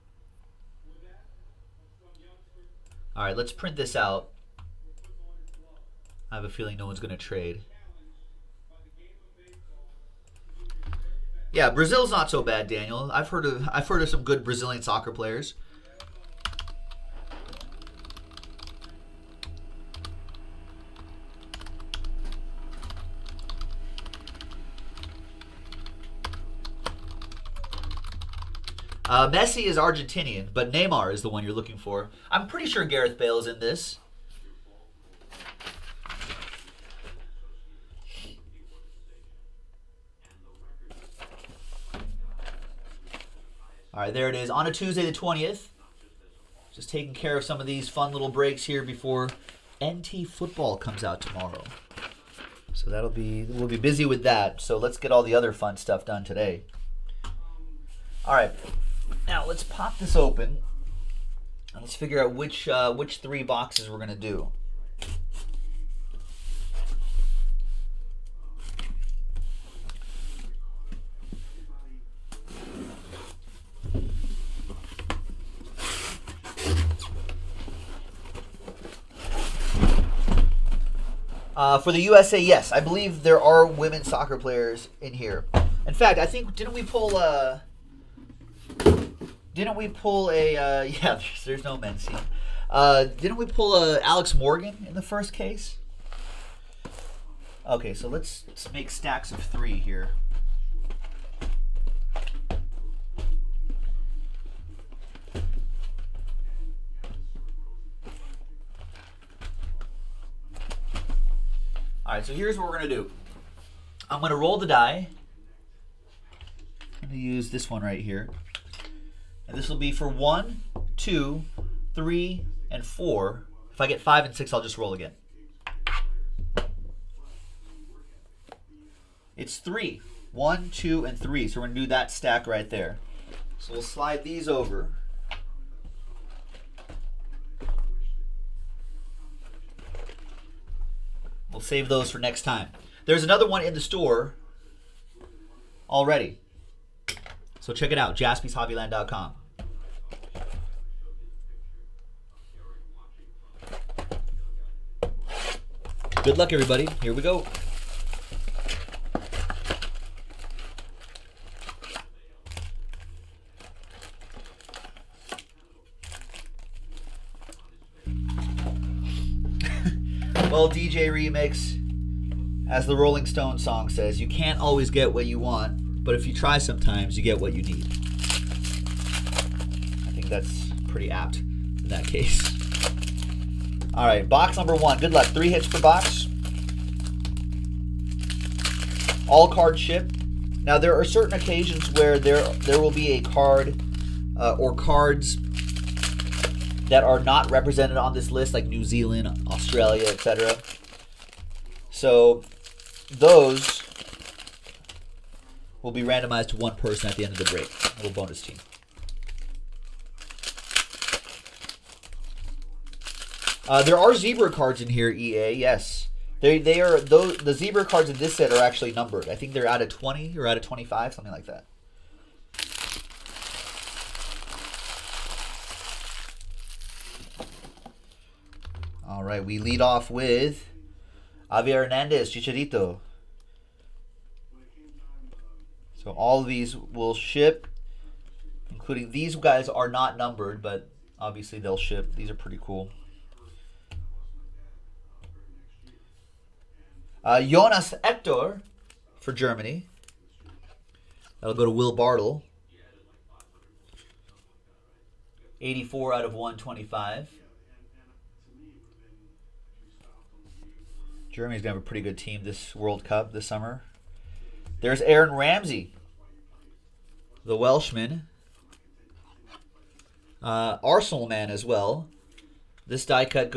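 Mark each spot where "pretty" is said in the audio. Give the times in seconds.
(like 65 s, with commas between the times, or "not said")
32 s, 180 s, 242 s, 261 s.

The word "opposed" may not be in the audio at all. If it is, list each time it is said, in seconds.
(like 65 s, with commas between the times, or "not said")
not said.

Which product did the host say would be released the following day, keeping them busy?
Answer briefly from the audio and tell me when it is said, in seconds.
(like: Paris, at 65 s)
NT football, at 49 s.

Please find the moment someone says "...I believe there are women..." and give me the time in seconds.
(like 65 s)
82 s.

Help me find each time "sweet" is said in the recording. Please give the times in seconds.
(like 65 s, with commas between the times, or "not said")
not said.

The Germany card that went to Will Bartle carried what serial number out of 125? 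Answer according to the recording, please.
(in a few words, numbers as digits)
84.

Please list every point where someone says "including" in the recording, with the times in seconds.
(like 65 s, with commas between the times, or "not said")
238 s.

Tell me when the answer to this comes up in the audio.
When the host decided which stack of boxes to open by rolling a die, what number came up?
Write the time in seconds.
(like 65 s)
129 s.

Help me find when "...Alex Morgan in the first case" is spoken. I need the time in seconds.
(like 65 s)
94 s.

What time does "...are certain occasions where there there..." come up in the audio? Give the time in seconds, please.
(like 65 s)
190 s.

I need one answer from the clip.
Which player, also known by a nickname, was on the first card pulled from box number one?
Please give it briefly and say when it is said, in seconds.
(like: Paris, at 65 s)
Javier Hernandez, at 231 s.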